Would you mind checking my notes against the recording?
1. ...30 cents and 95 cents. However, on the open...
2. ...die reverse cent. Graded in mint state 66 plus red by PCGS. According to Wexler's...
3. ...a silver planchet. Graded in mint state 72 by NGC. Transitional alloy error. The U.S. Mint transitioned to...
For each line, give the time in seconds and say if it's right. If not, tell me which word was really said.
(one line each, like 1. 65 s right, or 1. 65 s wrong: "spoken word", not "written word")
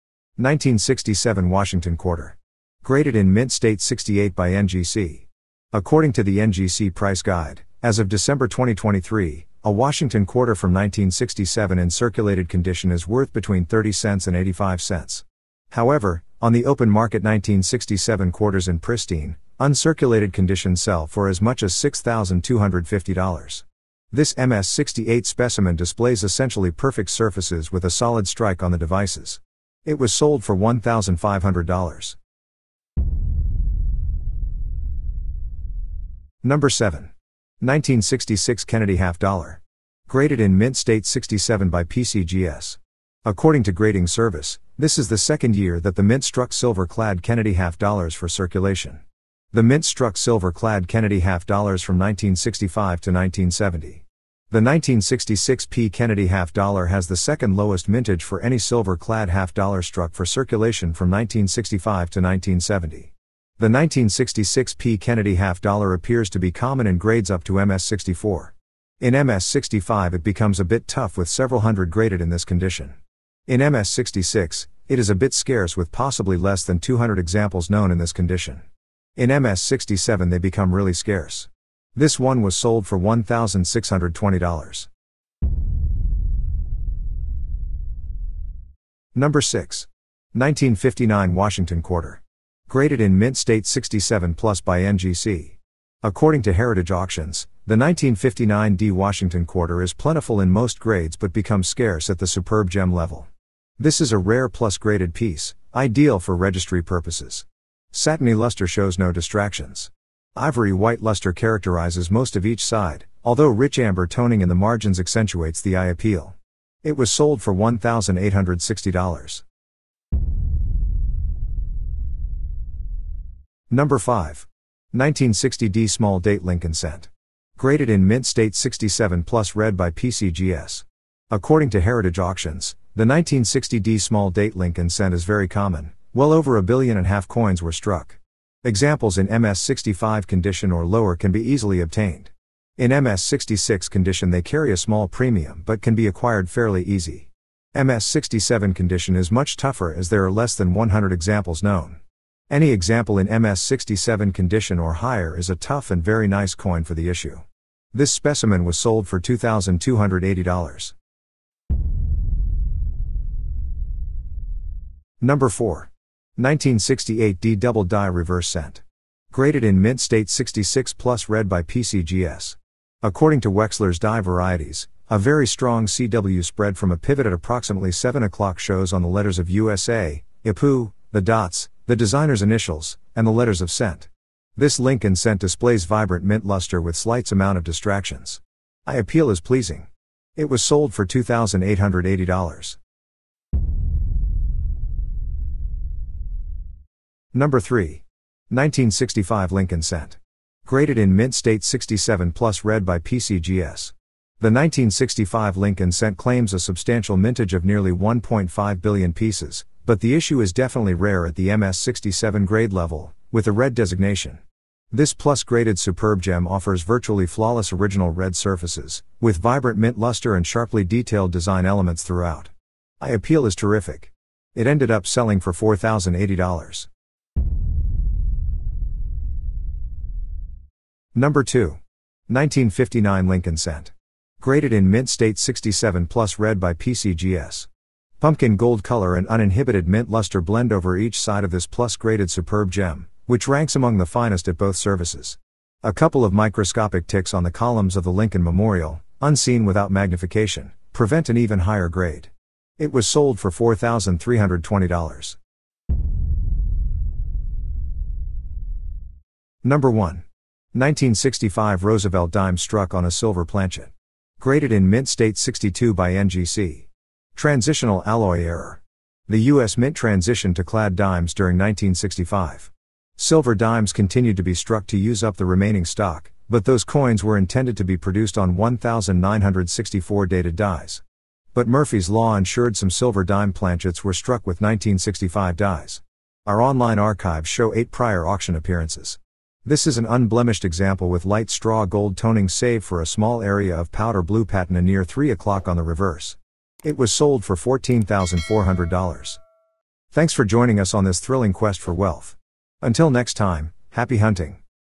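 1. 13 s wrong: "85", not "95"
2. 167 s right
3. 263 s wrong: "62", not "72".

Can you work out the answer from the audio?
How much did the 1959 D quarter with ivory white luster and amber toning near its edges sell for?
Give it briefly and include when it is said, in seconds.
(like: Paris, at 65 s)
$1,860, at 117 s.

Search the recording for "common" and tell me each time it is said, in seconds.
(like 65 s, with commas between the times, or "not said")
66 s, 135 s.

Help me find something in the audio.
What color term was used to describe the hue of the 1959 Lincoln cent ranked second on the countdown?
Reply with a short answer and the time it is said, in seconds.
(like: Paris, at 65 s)
Pumpkin gold, at 238 s.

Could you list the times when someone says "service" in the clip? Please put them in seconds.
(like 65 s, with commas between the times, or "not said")
44 s, 244 s.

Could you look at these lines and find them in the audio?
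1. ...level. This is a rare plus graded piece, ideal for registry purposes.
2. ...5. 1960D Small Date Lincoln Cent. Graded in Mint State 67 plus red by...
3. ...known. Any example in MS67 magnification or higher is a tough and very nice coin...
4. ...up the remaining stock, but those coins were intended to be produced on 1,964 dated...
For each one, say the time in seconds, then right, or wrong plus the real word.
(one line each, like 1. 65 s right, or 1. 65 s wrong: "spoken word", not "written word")
1. 102 s right
2. 123 s right
3. 151 s wrong: "condition", not "magnification"
4. 275 s right.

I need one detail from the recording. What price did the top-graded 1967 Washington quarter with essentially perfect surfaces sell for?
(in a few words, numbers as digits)
$1,500.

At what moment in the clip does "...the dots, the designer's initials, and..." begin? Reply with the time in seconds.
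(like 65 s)
181 s.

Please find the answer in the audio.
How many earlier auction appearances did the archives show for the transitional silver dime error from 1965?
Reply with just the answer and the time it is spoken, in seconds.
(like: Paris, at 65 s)
8, at 287 s.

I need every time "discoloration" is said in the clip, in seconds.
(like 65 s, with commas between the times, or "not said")
not said.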